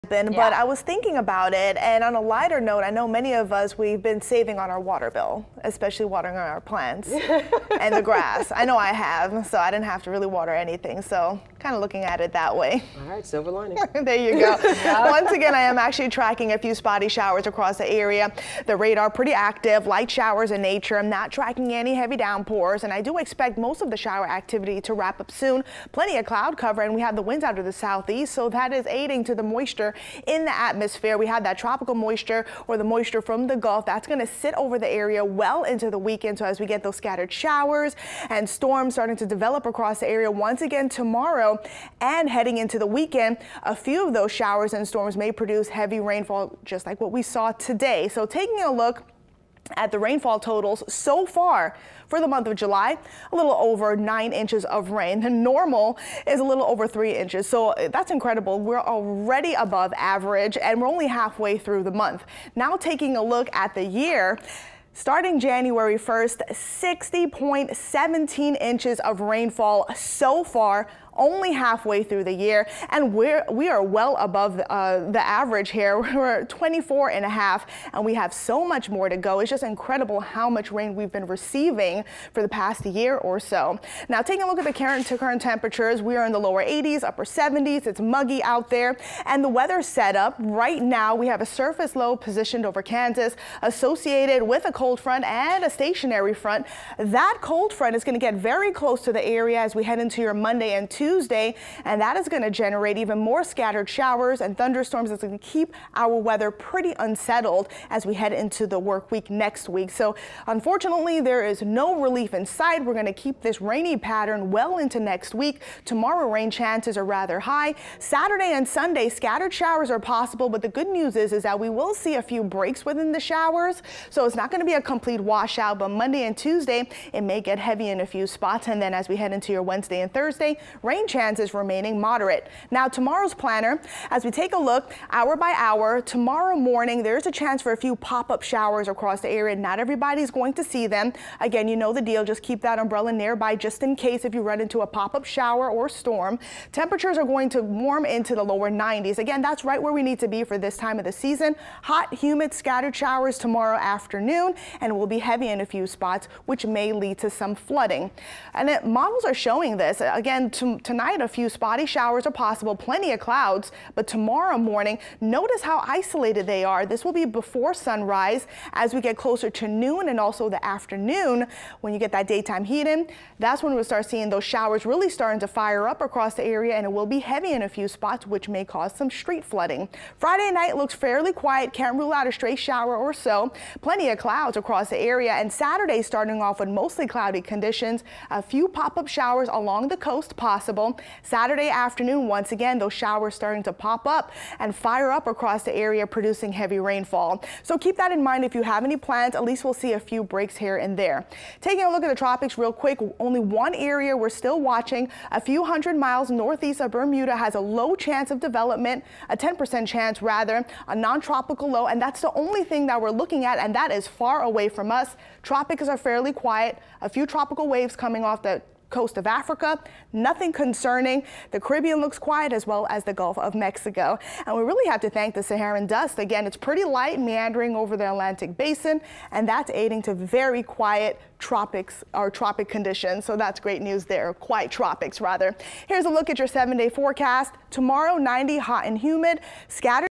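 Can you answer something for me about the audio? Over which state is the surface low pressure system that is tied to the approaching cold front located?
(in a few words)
Kansas.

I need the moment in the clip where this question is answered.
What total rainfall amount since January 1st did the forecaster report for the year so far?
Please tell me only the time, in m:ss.
1:06.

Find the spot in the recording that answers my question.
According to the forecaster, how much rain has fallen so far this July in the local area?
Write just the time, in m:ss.
0:53.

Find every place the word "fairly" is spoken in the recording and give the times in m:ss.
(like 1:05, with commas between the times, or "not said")
3:00, 3:35.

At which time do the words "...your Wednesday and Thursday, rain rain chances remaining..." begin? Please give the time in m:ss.
2:09.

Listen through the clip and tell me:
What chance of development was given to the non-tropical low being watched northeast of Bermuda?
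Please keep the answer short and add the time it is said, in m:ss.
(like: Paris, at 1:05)
10%, at 3:29.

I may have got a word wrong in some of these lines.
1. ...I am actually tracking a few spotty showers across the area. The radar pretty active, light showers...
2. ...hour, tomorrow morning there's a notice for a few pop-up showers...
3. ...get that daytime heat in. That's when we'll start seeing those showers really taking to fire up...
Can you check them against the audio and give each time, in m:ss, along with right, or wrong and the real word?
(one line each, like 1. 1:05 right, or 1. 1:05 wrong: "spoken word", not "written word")
1. 0:15 right
2. 2:15 wrong: "chance", not "notice"
3. 2:51 wrong: "starting", not "taking".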